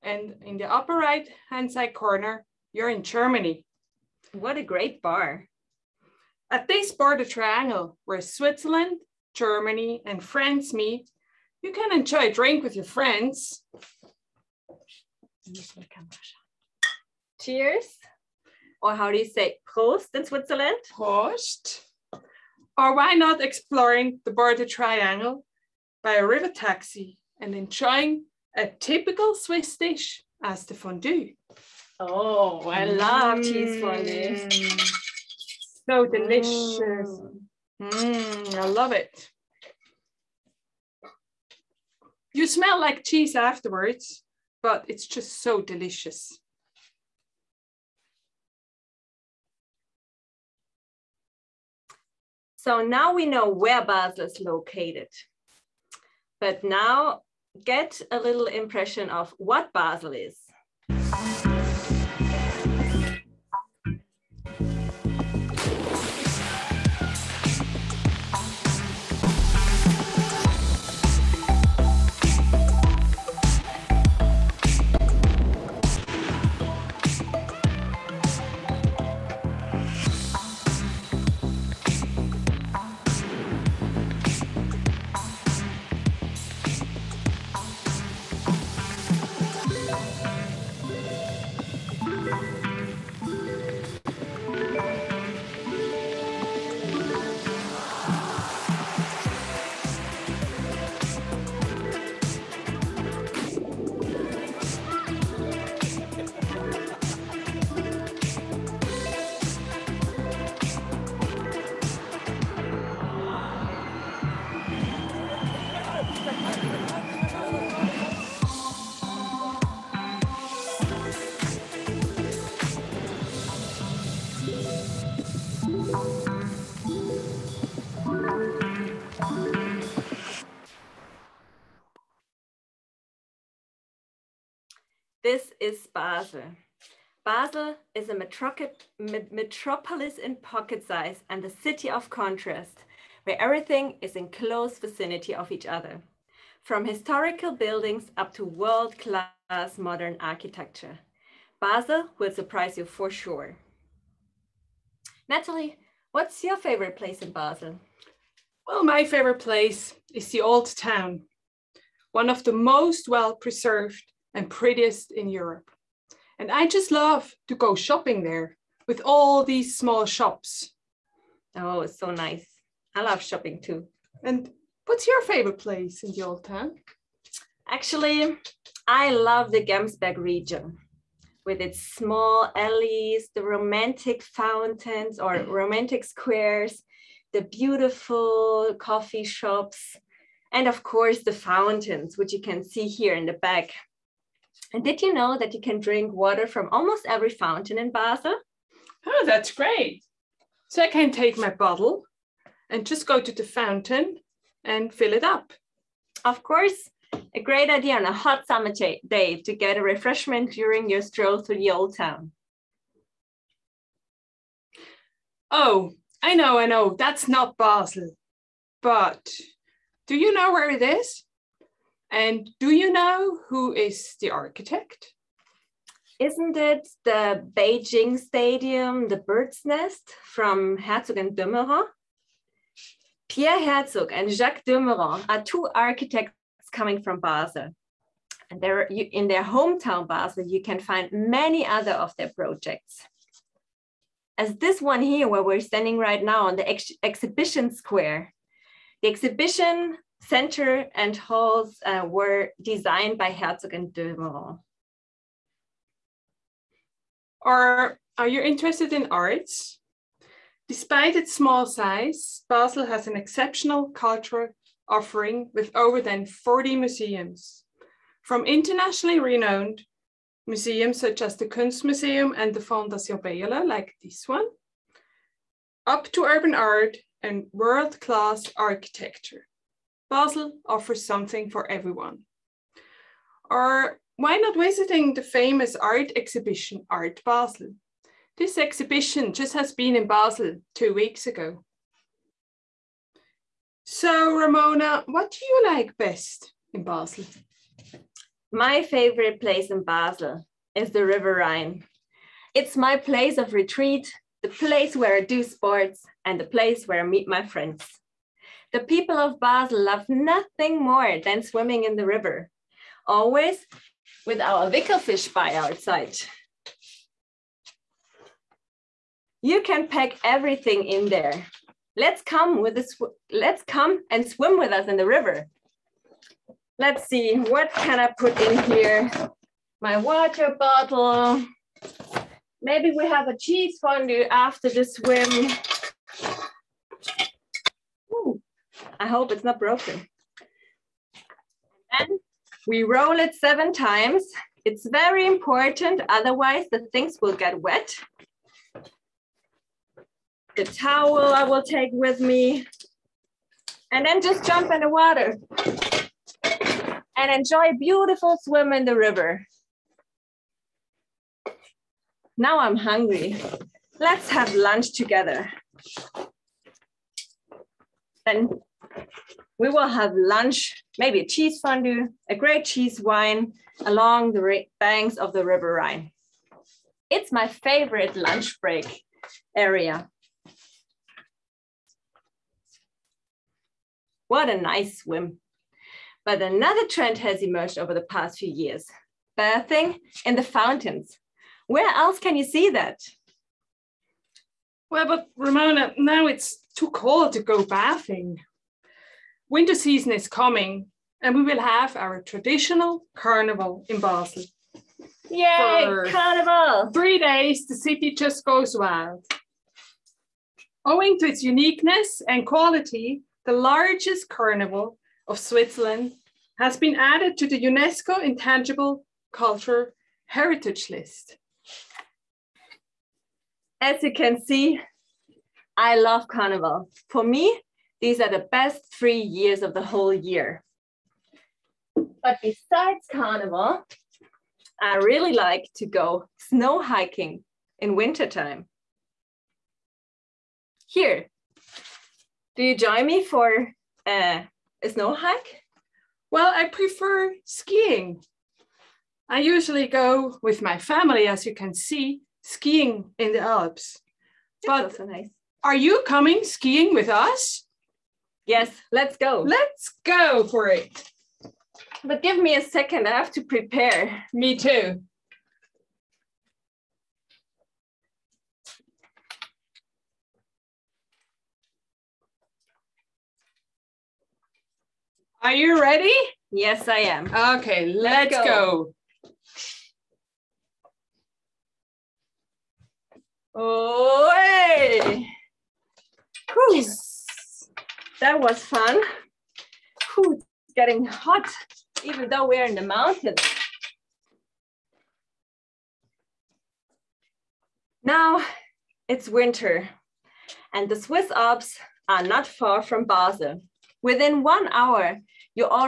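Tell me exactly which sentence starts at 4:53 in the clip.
So Ramona, what do you like best in Basel?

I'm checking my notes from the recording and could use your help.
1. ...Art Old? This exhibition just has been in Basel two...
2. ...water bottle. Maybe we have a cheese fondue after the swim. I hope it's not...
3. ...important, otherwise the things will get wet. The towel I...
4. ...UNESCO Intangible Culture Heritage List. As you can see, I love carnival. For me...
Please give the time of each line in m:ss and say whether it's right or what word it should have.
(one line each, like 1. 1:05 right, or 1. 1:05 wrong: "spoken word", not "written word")
1. 4:46 wrong: "Basel", not "Old"
2. 5:29 right
3. 5:45 right
4. 6:57 right.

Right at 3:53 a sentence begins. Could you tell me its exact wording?
Pierre Herzog and Jacques de Meuron are two architects coming from Basel.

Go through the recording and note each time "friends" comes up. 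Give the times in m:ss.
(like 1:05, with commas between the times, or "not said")
0:12, 5:07.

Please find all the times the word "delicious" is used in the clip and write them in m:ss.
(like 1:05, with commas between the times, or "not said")
0:36, 0:45.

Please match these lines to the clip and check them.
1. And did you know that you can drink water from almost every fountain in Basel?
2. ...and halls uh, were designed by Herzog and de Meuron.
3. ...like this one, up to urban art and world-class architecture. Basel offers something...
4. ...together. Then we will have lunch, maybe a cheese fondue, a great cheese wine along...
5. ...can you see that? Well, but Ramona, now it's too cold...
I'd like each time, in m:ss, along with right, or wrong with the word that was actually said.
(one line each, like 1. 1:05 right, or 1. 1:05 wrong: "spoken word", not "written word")
1. 3:14 right
2. 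4:10 right
3. 4:33 right
4. 6:04 right
5. 6:32 right.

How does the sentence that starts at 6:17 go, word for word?
It's my favorite lunch break area.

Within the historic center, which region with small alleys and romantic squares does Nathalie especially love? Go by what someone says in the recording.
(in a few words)
Gemsberg.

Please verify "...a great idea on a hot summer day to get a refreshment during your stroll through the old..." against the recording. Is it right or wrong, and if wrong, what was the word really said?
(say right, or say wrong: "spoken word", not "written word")
right.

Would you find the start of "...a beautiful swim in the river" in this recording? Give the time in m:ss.
5:57.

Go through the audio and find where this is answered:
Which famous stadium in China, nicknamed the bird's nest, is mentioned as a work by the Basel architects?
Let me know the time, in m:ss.
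3:47.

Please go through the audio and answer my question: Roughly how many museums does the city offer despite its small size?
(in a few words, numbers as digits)
Over 40.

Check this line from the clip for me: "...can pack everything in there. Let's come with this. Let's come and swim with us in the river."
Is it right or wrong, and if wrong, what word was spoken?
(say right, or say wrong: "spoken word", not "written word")
right.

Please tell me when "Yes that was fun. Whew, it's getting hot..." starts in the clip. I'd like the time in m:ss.
8:06.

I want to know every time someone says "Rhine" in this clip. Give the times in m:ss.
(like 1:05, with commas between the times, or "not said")
5:01, 6:15.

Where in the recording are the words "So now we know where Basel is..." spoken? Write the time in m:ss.
0:52.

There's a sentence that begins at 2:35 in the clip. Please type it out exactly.
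Nathalie, what's your favorite place in Basel?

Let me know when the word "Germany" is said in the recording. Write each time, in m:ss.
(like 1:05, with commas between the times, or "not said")
0:03, 0:09.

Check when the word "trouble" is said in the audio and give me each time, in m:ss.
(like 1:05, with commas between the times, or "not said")
not said.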